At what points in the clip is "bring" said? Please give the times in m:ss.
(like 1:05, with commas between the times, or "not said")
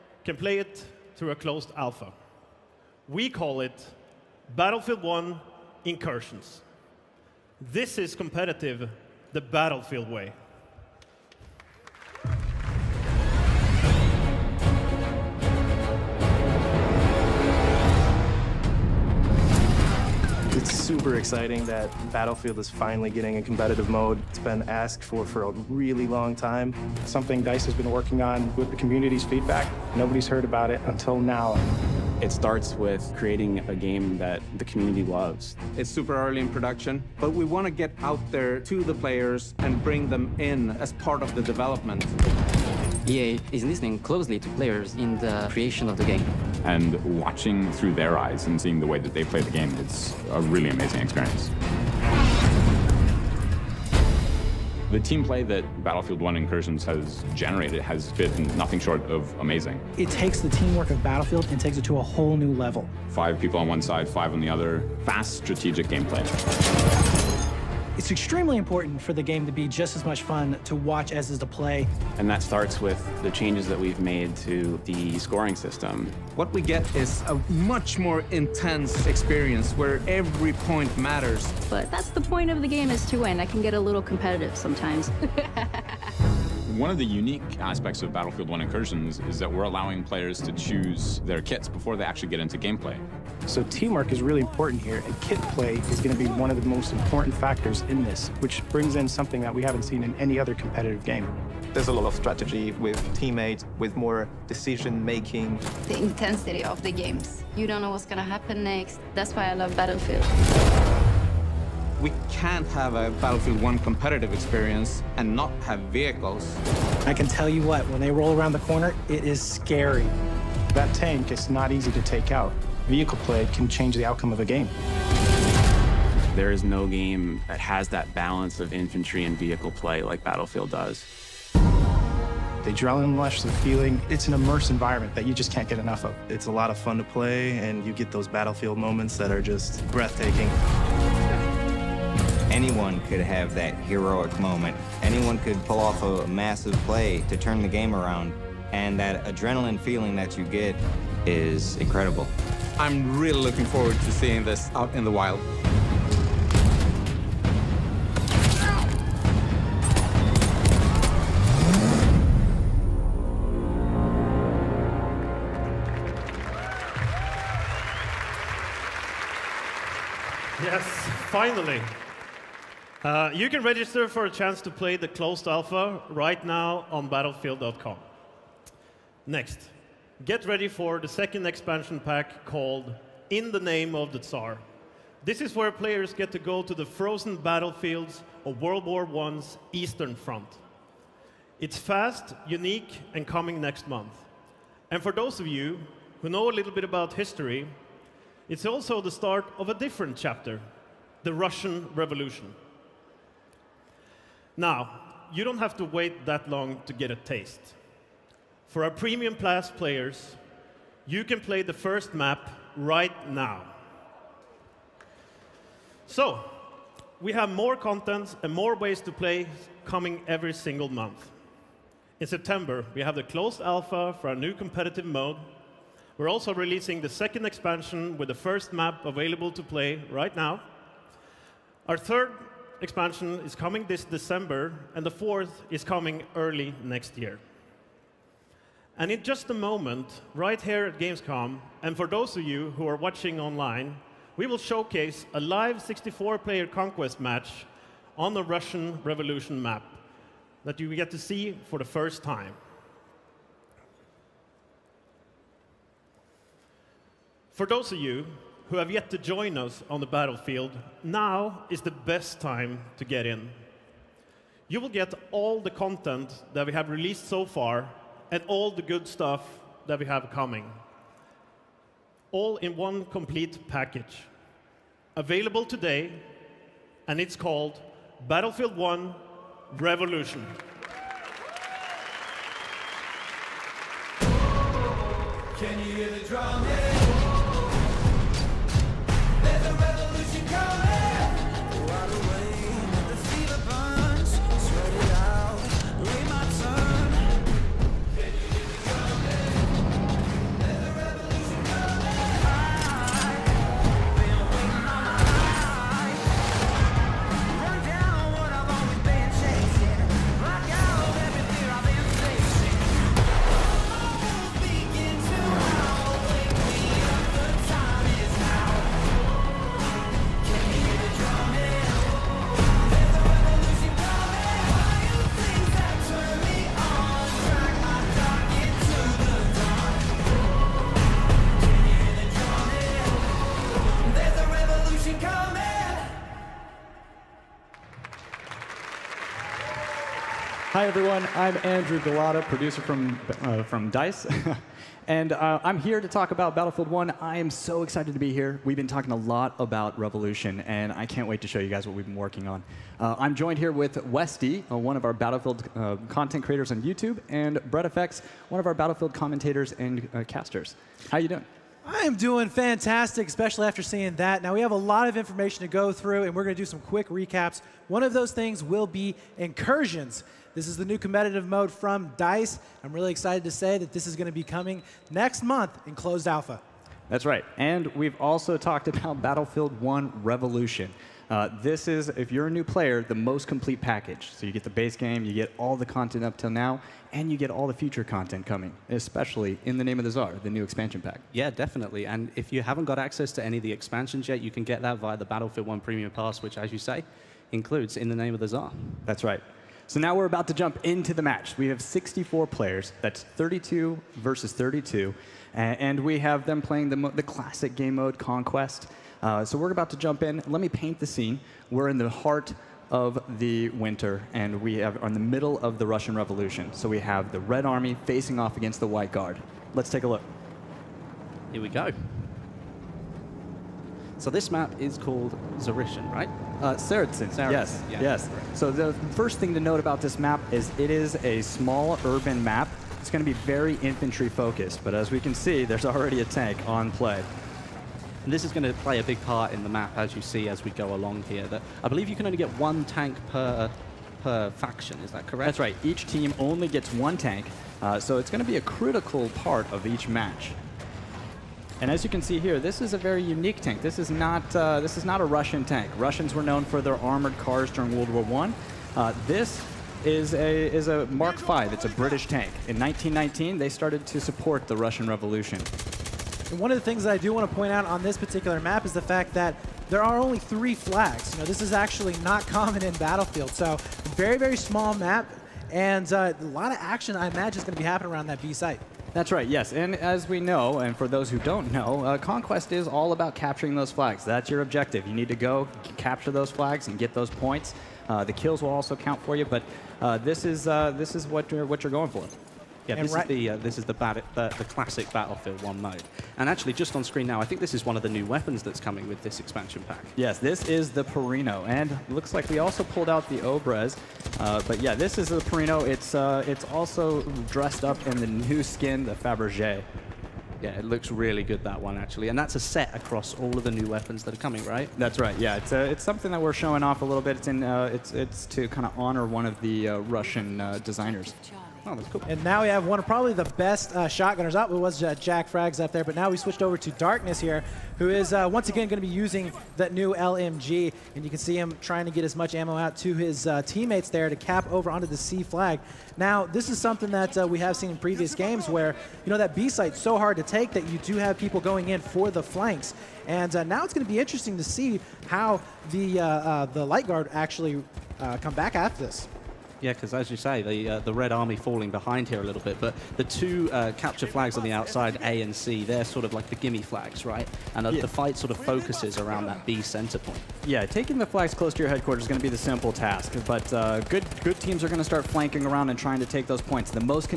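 0:39, 1:38.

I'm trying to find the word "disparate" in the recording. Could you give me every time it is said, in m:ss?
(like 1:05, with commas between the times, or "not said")
not said.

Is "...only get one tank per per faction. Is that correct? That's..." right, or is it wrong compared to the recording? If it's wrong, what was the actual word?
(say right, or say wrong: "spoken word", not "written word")
right.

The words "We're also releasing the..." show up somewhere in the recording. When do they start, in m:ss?
3:46.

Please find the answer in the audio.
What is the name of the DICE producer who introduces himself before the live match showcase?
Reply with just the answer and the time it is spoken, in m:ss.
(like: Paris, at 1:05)
Andrew Gulotta, at 5:41.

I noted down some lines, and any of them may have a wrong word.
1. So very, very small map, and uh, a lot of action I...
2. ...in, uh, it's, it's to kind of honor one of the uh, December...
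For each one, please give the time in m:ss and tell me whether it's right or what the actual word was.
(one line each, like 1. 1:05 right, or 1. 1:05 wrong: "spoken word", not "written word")
1. 7:53 right
2. 8:37 wrong: "Russian", not "December".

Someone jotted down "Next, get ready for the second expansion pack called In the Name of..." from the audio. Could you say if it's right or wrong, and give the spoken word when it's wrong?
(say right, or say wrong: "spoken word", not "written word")
right.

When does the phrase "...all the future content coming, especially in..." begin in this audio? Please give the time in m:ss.
6:27.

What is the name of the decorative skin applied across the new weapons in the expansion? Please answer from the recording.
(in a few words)
Fabergé.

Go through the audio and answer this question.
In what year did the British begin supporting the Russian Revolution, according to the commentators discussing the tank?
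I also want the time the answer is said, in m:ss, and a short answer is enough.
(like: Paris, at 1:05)
1919, at 7:42.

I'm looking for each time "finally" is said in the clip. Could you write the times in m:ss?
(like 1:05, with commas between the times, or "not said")
0:22, 2:51.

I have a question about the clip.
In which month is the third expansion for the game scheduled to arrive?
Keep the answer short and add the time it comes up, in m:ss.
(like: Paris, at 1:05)
December, at 3:54.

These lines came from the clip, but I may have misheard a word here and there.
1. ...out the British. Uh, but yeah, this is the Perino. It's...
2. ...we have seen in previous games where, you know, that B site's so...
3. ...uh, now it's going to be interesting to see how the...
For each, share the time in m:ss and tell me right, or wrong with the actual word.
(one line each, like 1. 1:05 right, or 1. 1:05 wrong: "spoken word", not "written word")
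1. 8:23 wrong: "Obrez", not "British"
2. 8:57 right
3. 9:03 right.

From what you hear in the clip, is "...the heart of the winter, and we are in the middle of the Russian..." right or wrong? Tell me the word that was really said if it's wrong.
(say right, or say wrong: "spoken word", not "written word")
right.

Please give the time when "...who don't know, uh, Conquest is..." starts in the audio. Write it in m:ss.
8:01.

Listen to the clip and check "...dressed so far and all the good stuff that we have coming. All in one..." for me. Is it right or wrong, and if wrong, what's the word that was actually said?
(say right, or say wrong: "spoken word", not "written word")
wrong: "released", not "dressed".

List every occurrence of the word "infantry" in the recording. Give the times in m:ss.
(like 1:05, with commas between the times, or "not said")
2:08, 7:13.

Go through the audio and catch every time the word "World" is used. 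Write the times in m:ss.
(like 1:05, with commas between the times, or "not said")
3:08, 7:37.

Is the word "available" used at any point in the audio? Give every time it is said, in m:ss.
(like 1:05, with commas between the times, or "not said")
3:49, 4:35.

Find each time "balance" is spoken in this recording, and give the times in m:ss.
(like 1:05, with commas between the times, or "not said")
2:08.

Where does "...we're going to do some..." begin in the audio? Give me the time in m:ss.
6:06.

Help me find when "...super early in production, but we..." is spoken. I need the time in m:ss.
0:35.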